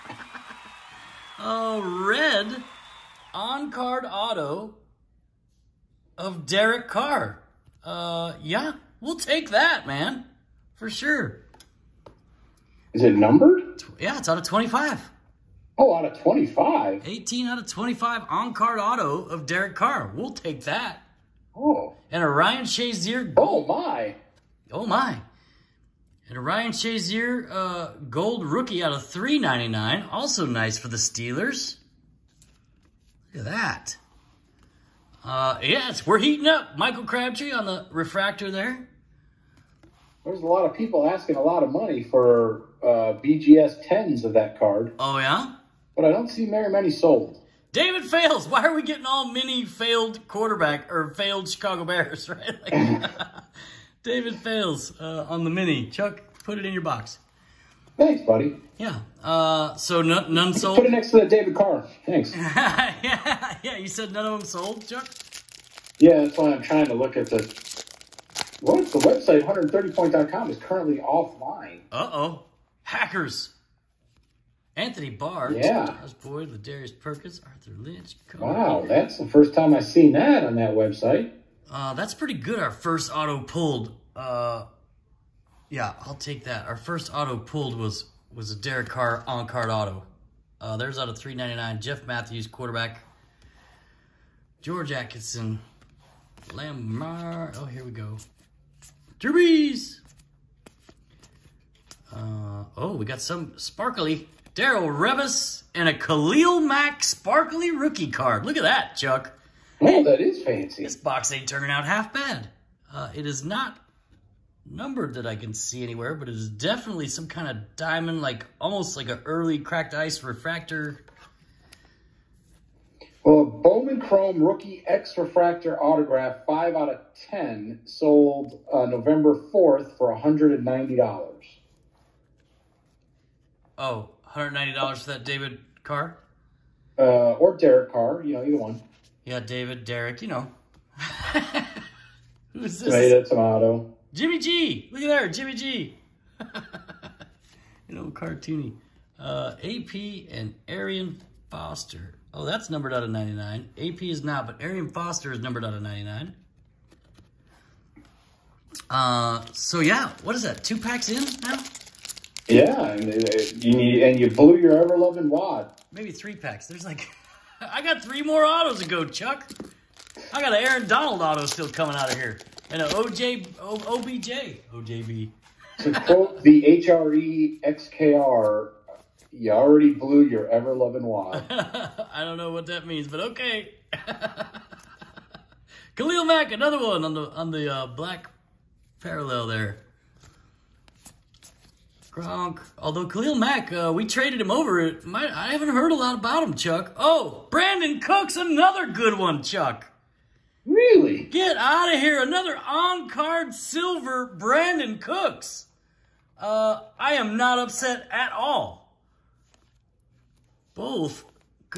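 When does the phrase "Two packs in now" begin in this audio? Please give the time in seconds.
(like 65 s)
160 s.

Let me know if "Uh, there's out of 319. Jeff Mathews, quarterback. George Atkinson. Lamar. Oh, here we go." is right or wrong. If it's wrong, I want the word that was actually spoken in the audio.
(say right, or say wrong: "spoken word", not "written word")
wrong: "399", not "319".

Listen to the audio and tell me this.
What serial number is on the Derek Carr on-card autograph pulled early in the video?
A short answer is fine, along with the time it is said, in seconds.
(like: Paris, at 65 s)
18/25, at 17 s.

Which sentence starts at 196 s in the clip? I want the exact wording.
Oh, Brandin Cooks another good one, Chuck.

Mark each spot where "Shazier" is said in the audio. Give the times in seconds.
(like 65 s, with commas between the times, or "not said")
22 s, 26 s.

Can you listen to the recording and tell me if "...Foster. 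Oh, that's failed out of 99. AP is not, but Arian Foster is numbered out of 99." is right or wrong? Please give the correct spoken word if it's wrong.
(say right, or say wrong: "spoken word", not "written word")
wrong: "numbered", not "failed".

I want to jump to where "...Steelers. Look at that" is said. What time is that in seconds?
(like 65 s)
30 s.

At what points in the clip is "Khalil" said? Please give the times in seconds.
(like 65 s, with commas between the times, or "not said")
105 s, 185 s, 193 s.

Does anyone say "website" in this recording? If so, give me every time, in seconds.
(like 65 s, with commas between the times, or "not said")
68 s, 80 s.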